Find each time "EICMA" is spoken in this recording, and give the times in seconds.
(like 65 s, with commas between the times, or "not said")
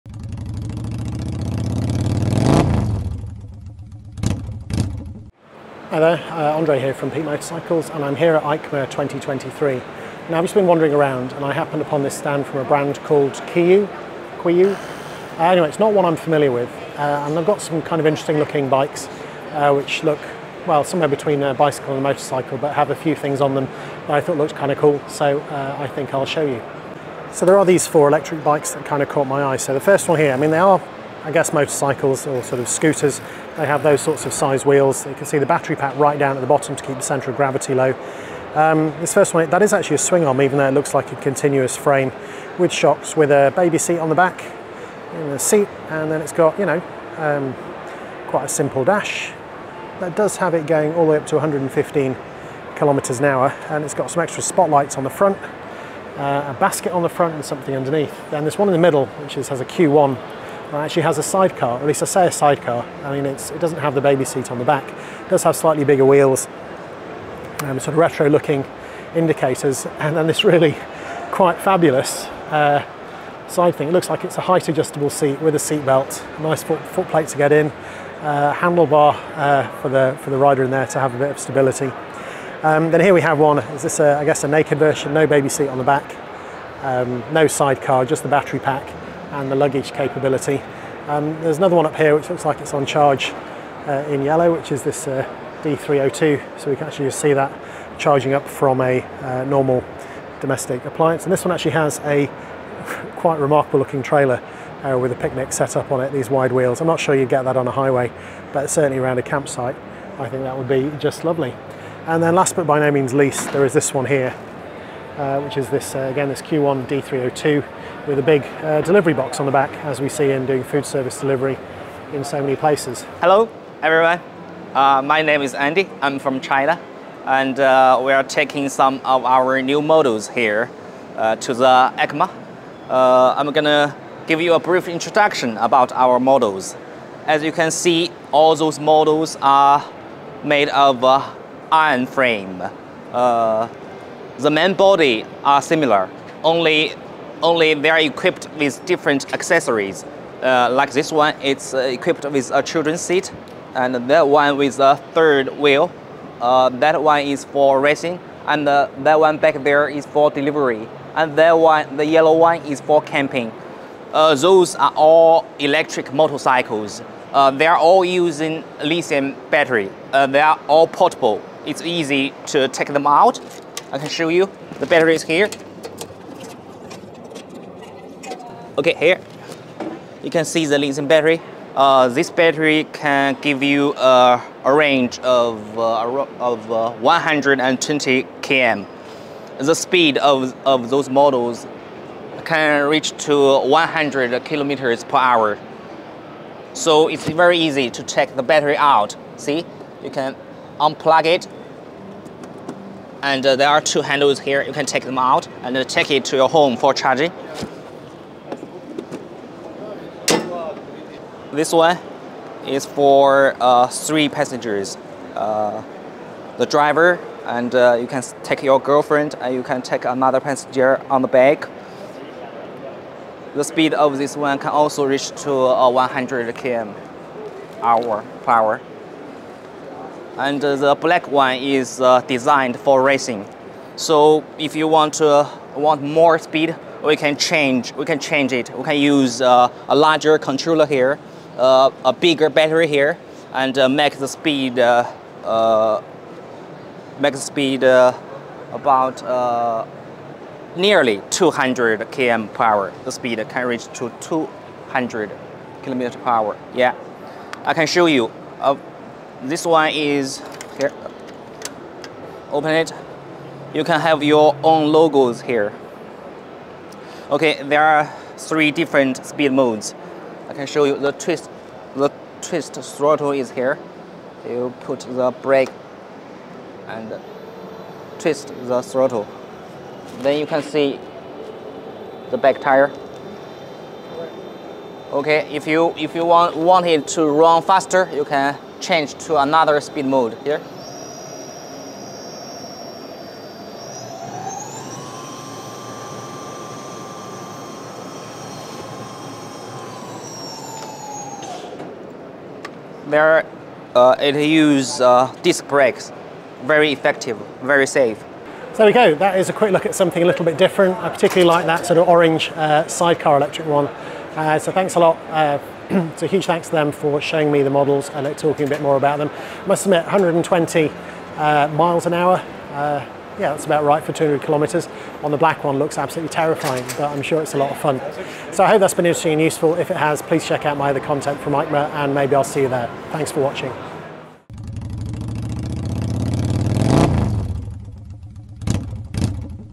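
8 s, 131 s.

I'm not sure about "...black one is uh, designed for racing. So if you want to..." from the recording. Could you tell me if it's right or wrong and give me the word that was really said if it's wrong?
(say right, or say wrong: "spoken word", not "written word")
right.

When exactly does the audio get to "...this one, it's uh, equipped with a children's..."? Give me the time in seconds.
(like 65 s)
150 s.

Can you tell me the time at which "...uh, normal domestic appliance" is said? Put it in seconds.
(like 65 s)
99 s.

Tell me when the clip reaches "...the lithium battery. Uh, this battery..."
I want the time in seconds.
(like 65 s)
180 s.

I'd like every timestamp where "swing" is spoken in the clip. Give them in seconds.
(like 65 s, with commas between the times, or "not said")
39 s.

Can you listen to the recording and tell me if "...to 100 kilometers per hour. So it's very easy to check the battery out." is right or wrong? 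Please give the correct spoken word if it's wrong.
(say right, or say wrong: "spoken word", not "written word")
right.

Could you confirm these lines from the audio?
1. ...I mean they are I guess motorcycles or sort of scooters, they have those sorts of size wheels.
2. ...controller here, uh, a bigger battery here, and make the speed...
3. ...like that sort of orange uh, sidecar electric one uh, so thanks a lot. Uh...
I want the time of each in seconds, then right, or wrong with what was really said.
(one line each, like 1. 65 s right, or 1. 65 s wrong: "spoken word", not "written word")
1. 30 s right
2. 240 s right
3. 311 s right.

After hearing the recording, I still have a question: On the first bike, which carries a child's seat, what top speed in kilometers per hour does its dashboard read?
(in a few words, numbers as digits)
115.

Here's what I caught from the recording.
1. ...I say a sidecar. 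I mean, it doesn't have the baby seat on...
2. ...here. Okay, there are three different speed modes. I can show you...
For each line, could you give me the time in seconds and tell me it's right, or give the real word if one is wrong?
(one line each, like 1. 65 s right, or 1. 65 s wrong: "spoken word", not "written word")
1. 62 s right
2. 265 s right.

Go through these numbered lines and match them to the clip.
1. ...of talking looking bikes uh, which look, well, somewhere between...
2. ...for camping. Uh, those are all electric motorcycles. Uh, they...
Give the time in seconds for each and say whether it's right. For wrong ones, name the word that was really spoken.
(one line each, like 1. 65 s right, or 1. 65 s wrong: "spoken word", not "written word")
1. 17 s wrong: "interesting", not "talking"
2. 162 s right.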